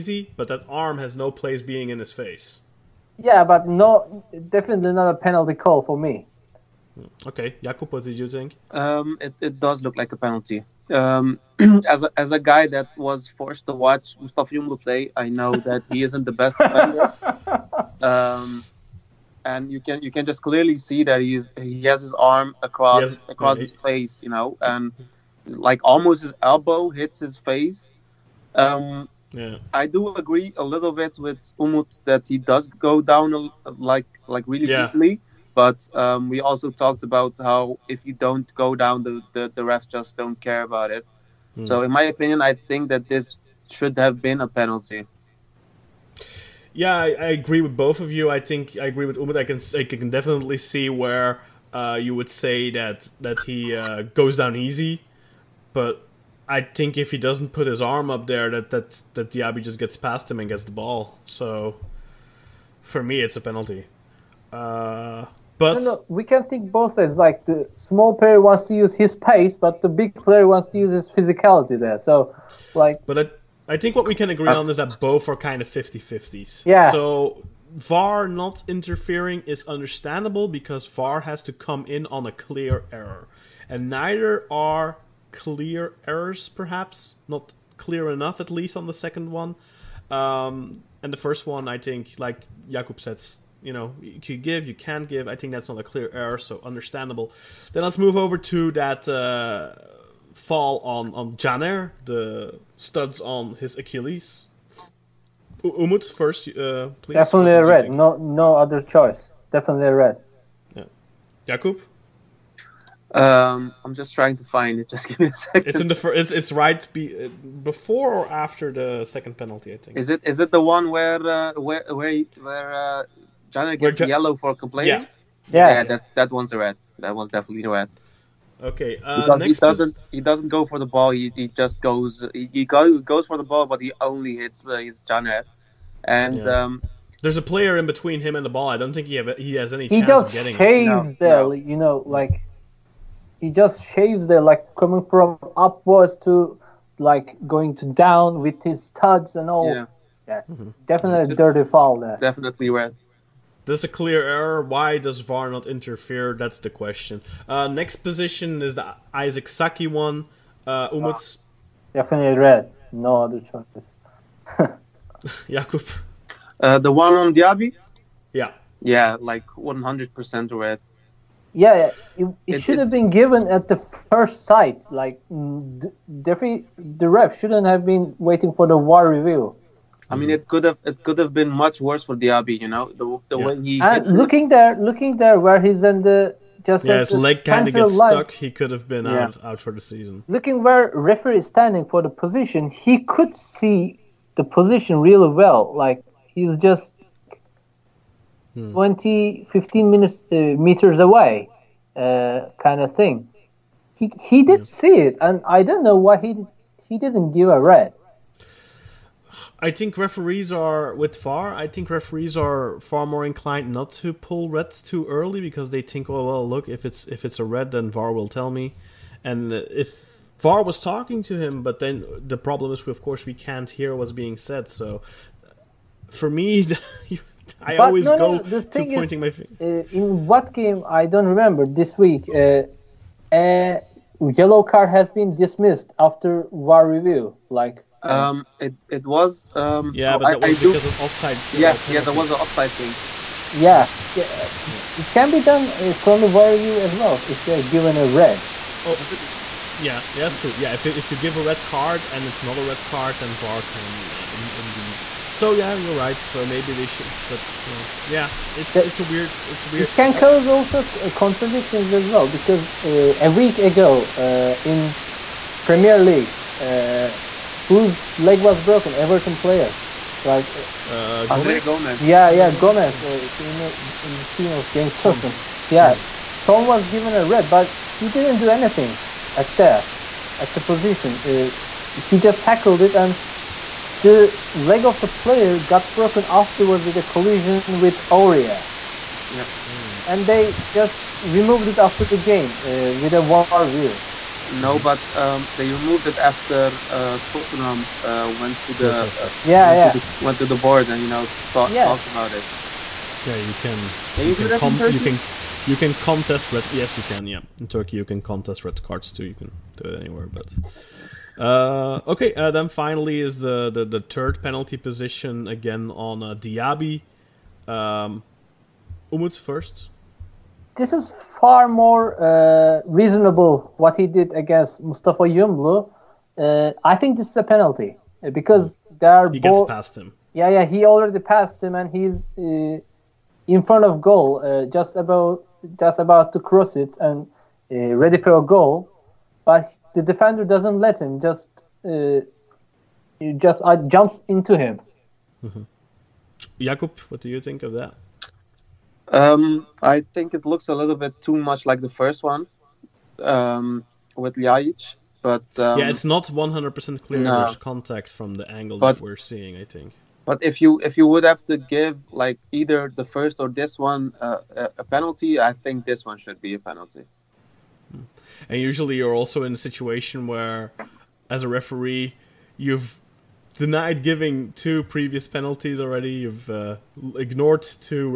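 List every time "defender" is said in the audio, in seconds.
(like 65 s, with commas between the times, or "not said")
16 s, 340 s.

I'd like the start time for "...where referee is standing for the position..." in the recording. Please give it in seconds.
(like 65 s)
190 s.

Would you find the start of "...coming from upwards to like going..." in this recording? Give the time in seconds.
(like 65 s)
144 s.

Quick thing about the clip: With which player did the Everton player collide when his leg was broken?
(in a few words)
Aurier.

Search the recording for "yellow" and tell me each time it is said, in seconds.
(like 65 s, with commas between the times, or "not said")
124 s, 234 s.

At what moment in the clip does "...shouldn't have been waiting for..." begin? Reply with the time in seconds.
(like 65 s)
177 s.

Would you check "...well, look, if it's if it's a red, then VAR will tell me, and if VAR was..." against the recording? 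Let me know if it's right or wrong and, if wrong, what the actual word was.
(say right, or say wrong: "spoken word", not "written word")
right.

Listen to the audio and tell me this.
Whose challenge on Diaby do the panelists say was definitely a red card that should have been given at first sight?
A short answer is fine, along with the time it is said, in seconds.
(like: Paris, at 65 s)
Isaac Saki, at 159 s.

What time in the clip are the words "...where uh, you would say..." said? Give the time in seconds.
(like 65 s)
50 s.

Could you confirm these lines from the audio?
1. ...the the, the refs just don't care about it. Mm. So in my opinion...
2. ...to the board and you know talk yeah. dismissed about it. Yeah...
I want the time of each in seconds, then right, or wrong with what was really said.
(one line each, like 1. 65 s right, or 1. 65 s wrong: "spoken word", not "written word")
1. 39 s right
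2. 300 s wrong: "talked", not "dismissed".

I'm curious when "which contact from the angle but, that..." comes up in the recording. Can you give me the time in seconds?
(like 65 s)
357 s.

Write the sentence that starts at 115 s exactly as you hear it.
It's in the fir- it's, it's right be- before or after the second penalty, I think.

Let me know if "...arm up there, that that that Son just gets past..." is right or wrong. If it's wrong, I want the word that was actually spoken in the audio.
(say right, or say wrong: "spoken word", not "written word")
wrong: "Diaby", not "Son".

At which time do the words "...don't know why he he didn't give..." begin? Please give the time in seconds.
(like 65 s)
205 s.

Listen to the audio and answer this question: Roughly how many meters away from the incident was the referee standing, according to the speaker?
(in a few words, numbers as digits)
15.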